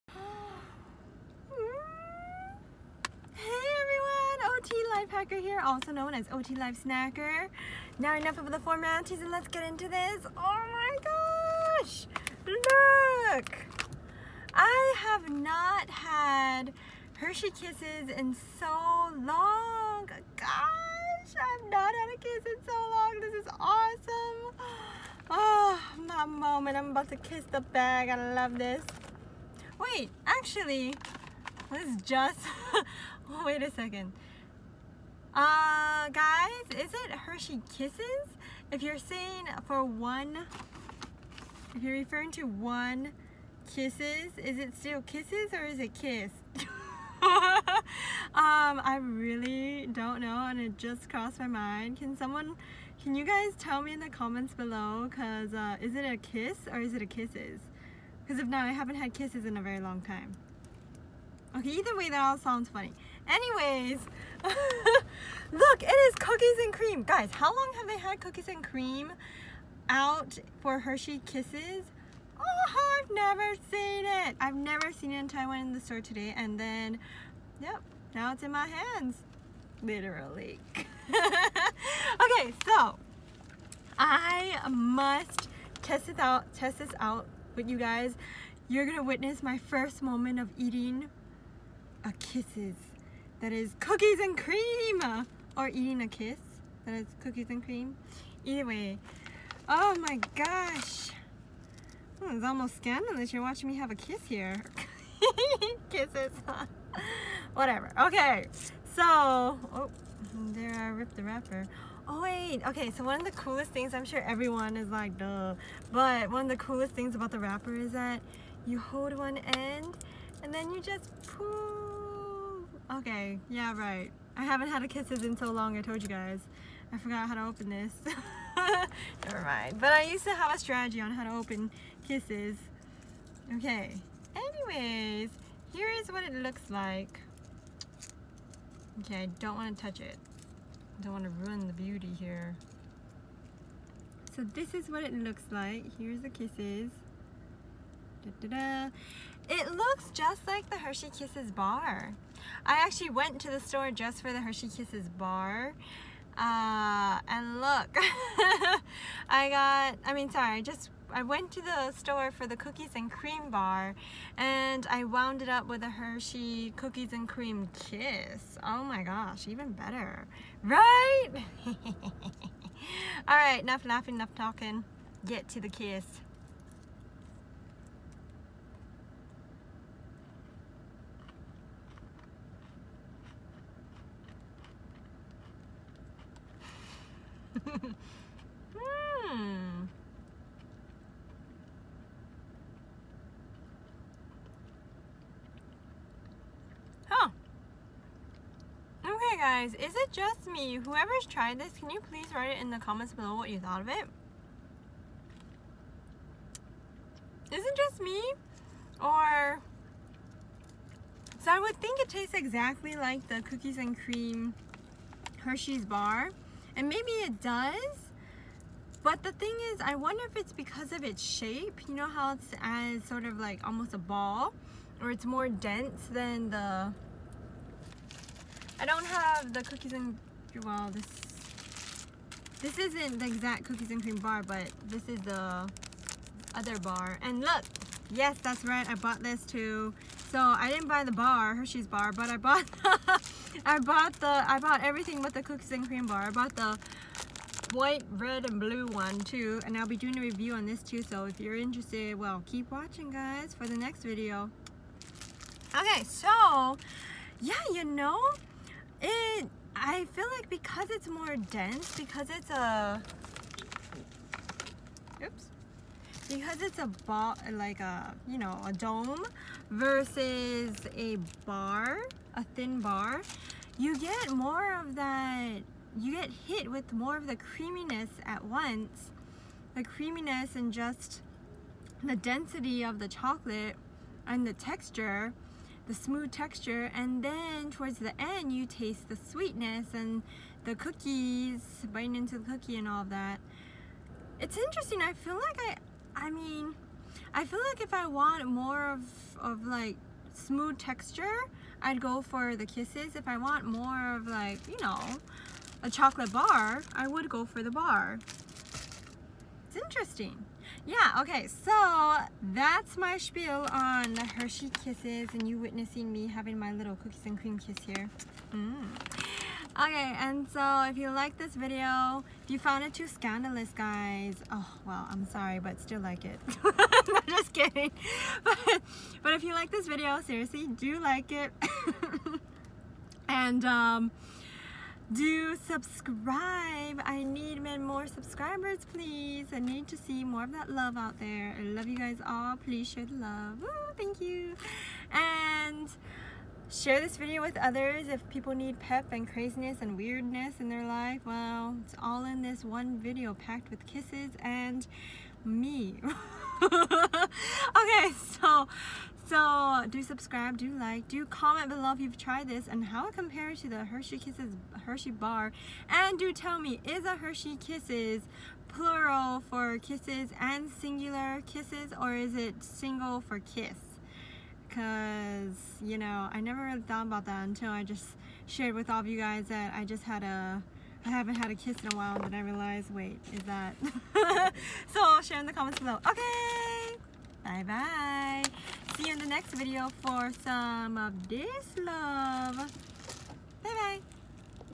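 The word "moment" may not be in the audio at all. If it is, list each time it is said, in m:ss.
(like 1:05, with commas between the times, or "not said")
0:26, 1:30.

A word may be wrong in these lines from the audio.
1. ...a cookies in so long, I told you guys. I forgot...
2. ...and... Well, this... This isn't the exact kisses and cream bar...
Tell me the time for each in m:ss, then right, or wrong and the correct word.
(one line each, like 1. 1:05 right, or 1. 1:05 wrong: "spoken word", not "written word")
1. 2:04 wrong: "kisses", not "cookies"
2. 3:49 wrong: "cookies", not "kisses".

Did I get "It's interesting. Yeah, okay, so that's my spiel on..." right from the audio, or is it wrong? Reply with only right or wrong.
right.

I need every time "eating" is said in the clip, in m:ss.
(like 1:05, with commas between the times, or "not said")
1:30, 1:35.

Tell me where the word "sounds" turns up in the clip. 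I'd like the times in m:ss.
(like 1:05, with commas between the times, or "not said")
1:02.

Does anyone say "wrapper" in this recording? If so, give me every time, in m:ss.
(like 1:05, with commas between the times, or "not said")
1:51, 1:57.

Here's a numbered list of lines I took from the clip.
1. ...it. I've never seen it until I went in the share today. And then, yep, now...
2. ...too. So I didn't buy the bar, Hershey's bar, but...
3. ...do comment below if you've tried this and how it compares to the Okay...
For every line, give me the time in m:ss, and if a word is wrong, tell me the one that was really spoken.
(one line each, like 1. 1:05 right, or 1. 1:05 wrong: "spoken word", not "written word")
1. 1:14 wrong: "store", not "share"
2. 3:59 right
3. 6:01 wrong: "Hershey", not "Okay".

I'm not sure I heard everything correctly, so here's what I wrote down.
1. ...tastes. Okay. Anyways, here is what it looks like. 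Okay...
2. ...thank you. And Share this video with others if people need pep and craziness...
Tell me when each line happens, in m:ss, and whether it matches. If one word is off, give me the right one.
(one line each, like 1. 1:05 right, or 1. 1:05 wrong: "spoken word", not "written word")
1. 2:12 wrong: "kisses", not "tastes"
2. 5:43 right.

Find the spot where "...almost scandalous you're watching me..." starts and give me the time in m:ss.
1:42.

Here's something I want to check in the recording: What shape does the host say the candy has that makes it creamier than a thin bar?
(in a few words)
A dome.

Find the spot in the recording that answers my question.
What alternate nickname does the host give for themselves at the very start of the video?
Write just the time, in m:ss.
0:06.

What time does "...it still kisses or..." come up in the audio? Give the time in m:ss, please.
0:44.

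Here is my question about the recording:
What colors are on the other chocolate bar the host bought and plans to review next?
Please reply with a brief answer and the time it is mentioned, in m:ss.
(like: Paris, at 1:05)
White, red, and blue, at 4:07.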